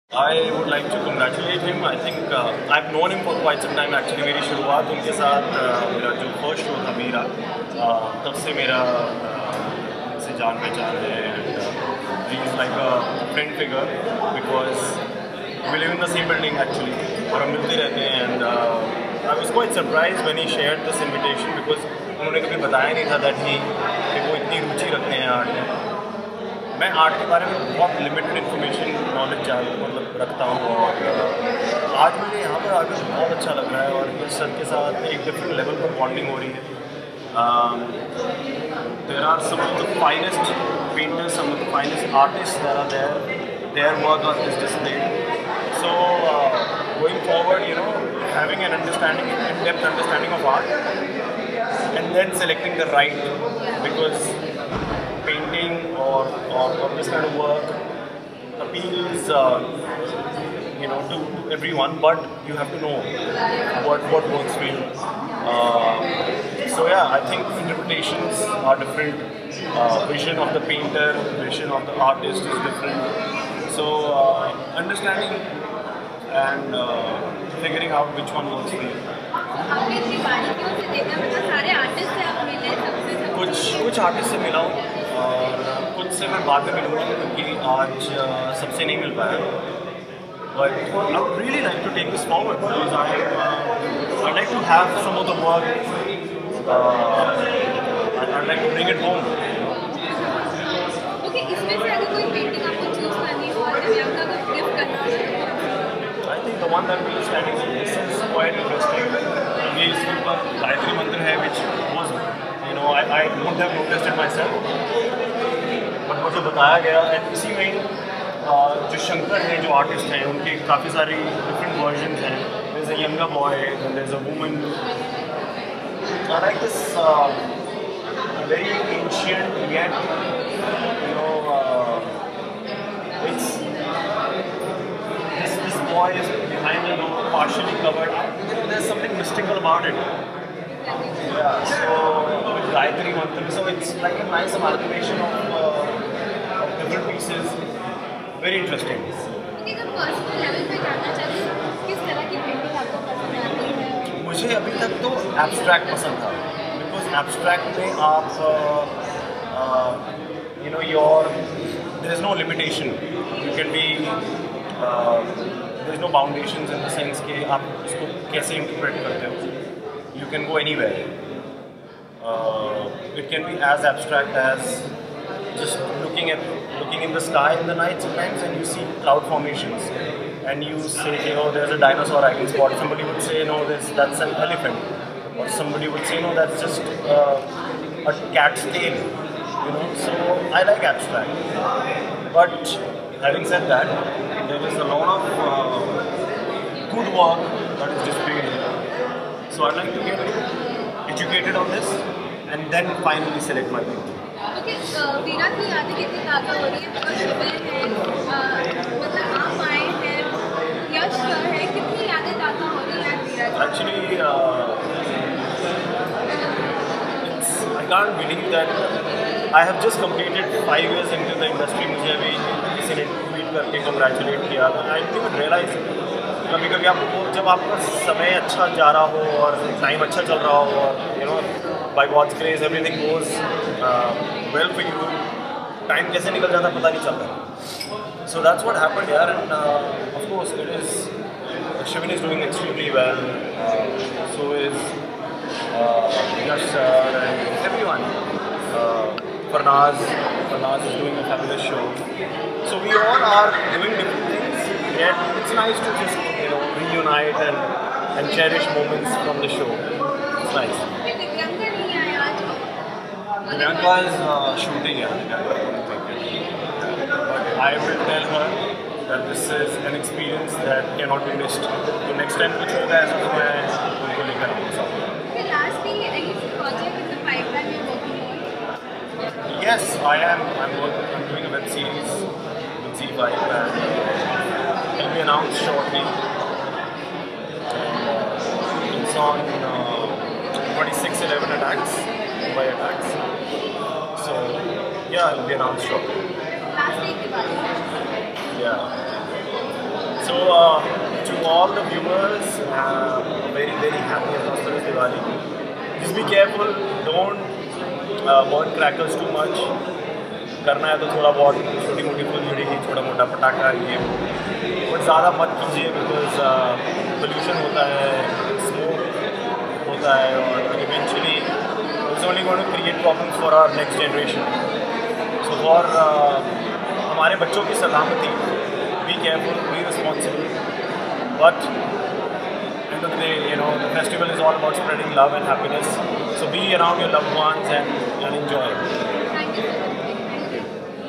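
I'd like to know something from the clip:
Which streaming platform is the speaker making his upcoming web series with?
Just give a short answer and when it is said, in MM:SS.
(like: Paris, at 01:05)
ZEE5, at 04:43.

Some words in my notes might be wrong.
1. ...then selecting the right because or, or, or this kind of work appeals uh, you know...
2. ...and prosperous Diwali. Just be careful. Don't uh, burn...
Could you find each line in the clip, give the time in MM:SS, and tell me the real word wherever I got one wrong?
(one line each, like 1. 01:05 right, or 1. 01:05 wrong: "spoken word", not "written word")
1. 00:52 right
2. 05:04 right.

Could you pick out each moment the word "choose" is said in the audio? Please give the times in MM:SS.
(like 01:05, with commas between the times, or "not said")
01:42.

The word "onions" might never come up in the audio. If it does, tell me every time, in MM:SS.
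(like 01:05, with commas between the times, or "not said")
not said.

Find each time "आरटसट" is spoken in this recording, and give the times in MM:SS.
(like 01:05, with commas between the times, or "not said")
00:42, 01:23, 01:59.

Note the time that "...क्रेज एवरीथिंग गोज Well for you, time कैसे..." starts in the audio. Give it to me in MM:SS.
03:52.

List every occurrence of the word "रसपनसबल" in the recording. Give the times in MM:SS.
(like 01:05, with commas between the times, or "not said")
05:29.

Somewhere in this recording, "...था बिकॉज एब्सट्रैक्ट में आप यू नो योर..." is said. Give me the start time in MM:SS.
02:36.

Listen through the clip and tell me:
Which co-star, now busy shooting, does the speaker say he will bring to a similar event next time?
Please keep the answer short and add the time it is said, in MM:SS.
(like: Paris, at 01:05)
Divyanka, at 04:23.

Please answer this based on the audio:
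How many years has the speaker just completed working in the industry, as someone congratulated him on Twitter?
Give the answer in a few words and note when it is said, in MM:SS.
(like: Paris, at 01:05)
5, at 03:40.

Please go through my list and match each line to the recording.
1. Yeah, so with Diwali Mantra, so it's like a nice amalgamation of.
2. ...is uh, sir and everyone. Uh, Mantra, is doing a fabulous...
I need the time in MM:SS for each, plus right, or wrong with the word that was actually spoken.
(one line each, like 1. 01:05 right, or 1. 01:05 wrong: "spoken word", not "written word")
1. 02:21 wrong: "Gayatri", not "Diwali"
2. 04:04 wrong: "Farnaz", not "Mantra".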